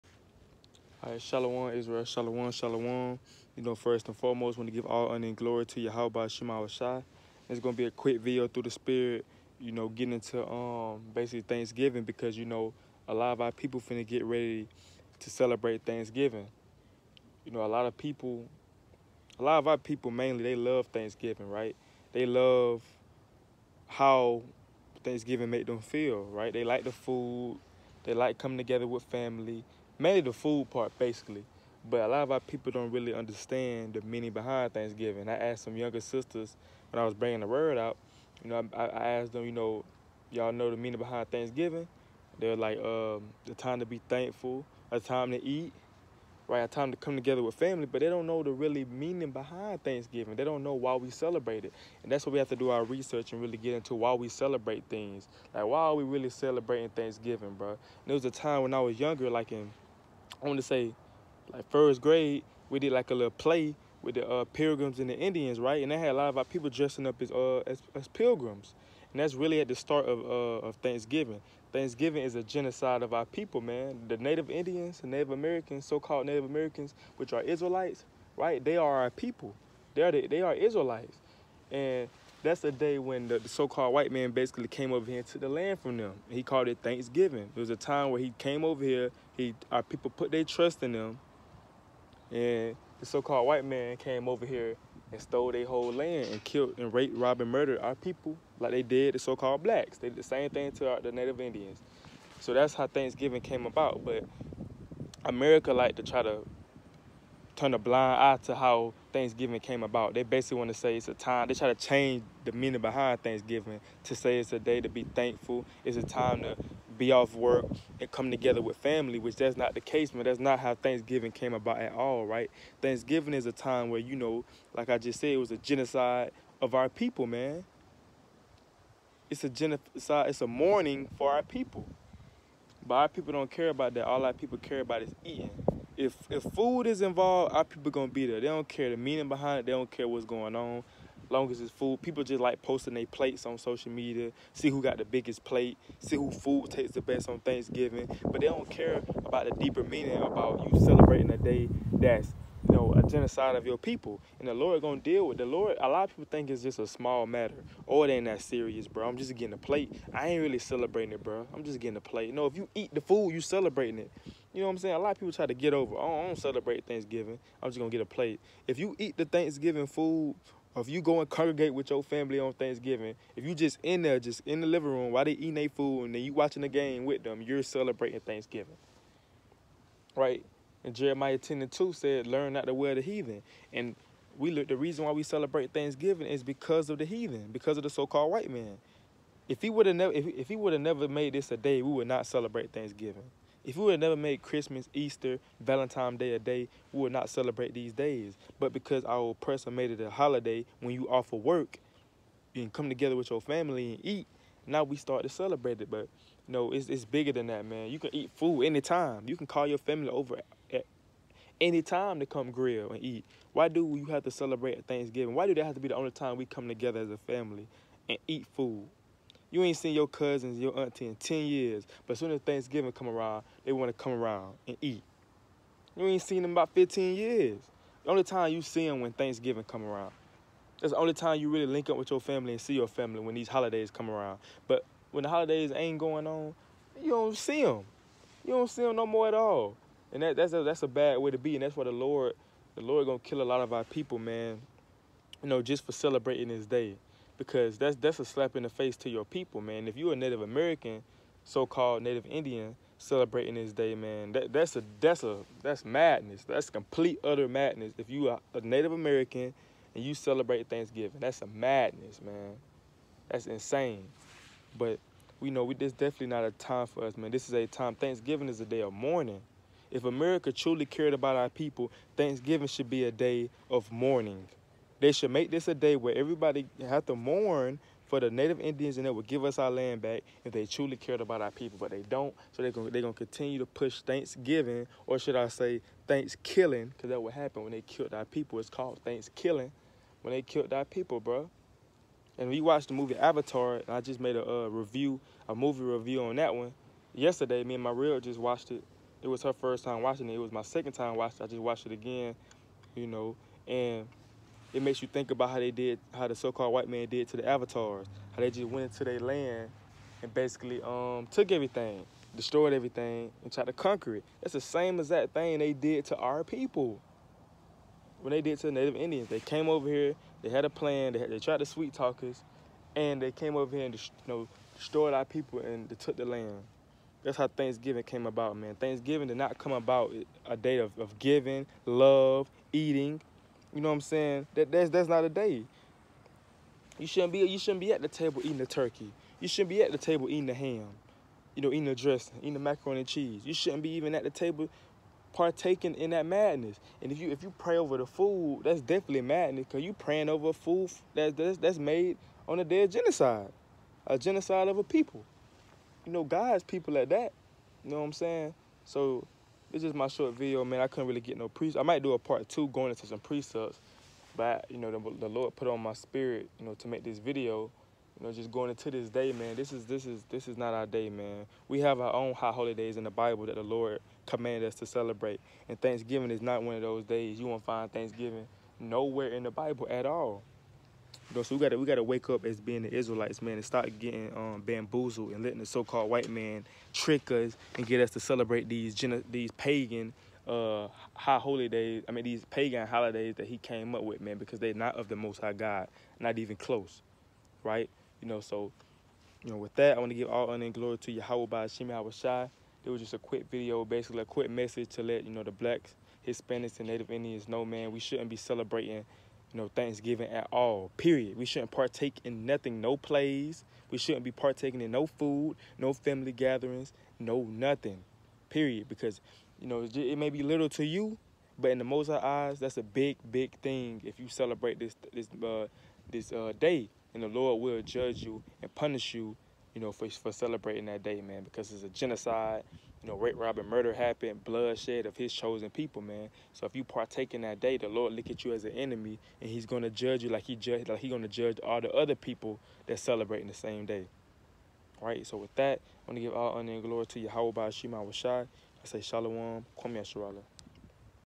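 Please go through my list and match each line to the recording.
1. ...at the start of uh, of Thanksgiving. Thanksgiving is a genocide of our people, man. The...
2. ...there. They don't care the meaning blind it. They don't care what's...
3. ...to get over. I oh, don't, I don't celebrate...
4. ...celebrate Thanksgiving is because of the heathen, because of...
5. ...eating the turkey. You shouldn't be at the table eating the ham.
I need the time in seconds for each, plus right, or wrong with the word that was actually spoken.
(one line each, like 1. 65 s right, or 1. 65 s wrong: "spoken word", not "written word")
1. 69 s right
2. 138 s wrong: "behind", not "blind"
3. 165 s right
4. 185 s right
5. 338 s right.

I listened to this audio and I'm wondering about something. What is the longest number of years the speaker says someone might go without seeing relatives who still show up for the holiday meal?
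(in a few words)
15 years.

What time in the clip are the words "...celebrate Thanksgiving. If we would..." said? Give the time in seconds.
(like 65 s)
192 s.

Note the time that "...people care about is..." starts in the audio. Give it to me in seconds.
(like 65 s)
134 s.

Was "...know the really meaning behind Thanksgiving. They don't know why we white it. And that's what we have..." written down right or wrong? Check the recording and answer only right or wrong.
wrong.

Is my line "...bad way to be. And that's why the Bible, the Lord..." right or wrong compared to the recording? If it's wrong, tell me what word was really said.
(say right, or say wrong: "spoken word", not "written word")
wrong: "Lord", not "Bible".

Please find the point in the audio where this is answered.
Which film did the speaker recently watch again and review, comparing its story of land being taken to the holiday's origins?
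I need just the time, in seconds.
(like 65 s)
293 s.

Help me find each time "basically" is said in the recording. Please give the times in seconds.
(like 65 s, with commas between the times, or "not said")
11 s, 30 s, 84 s, 110 s, 310 s, 403 s.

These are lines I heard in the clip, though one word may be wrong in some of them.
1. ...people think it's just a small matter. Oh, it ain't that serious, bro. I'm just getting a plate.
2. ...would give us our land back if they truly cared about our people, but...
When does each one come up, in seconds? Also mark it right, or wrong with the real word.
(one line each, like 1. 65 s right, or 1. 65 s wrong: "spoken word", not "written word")
1. 156 s right
2. 279 s right.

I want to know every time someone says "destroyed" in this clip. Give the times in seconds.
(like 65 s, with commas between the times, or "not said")
312 s, 324 s.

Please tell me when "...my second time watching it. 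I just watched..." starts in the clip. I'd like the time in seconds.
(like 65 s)
300 s.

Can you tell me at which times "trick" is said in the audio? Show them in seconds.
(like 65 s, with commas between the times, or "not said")
386 s.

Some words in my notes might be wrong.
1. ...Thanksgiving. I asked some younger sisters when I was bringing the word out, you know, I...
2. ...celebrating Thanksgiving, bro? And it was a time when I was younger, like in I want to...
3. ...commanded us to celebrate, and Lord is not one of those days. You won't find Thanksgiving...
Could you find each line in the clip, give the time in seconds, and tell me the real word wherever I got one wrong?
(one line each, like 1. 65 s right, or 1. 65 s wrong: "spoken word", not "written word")
1. 34 s right
2. 56 s right
3. 374 s wrong: "Thanksgiving", not "Lord".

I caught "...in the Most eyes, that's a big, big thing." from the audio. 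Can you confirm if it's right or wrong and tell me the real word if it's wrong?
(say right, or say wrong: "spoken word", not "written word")
right.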